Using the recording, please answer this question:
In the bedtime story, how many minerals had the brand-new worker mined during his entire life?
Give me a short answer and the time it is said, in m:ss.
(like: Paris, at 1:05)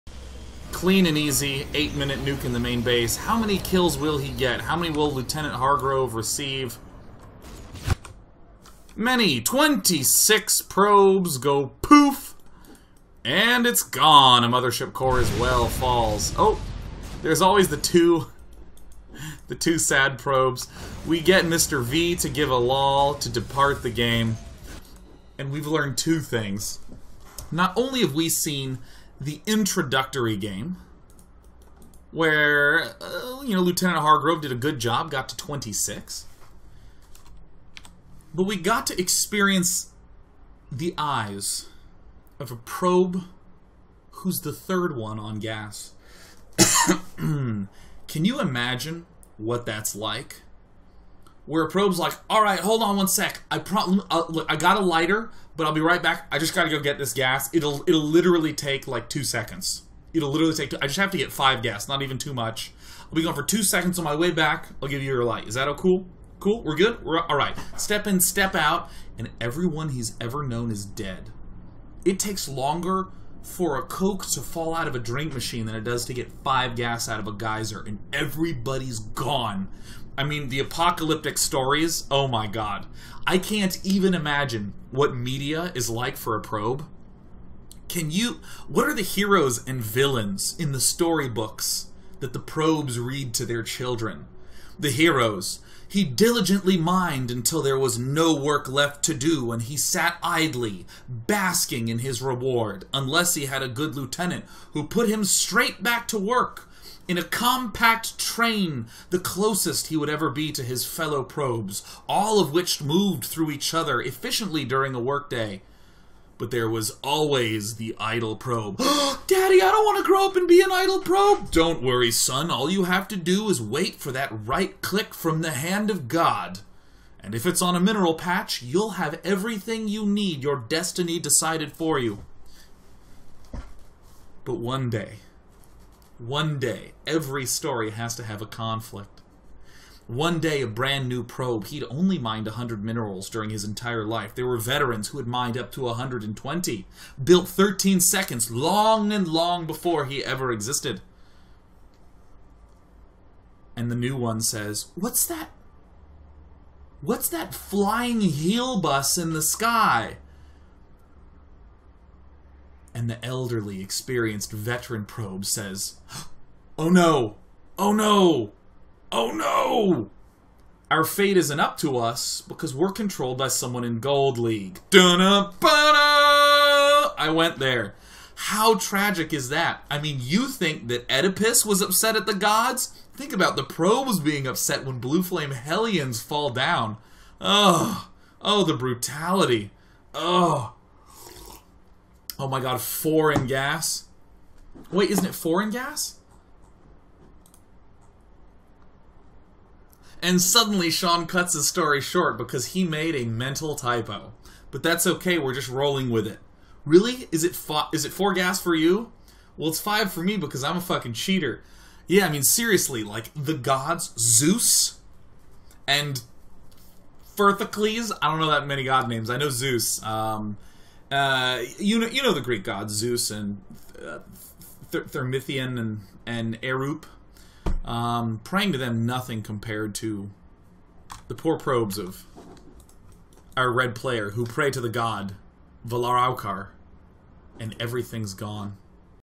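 100, at 2:21.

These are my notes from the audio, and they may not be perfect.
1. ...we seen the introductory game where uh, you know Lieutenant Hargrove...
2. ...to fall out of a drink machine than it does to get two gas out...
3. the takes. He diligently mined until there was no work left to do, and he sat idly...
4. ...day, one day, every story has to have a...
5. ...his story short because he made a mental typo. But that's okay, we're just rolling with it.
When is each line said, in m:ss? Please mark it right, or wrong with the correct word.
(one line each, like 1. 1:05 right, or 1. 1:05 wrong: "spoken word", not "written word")
1. 0:28 right
2. 1:14 wrong: "five", not "two"
3. 1:34 wrong: "heroes", not "takes"
4. 2:14 right
5. 3:21 right.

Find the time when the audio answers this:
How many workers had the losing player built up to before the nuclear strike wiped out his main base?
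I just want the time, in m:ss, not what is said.
0:08.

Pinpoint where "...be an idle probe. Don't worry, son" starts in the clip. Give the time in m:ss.
2:00.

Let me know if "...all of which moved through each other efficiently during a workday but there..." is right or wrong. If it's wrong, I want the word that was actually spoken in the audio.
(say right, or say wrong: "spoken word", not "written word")
right.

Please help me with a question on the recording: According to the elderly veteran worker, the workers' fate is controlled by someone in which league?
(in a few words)
Gold League.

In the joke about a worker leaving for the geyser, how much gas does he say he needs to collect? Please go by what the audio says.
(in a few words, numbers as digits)
5.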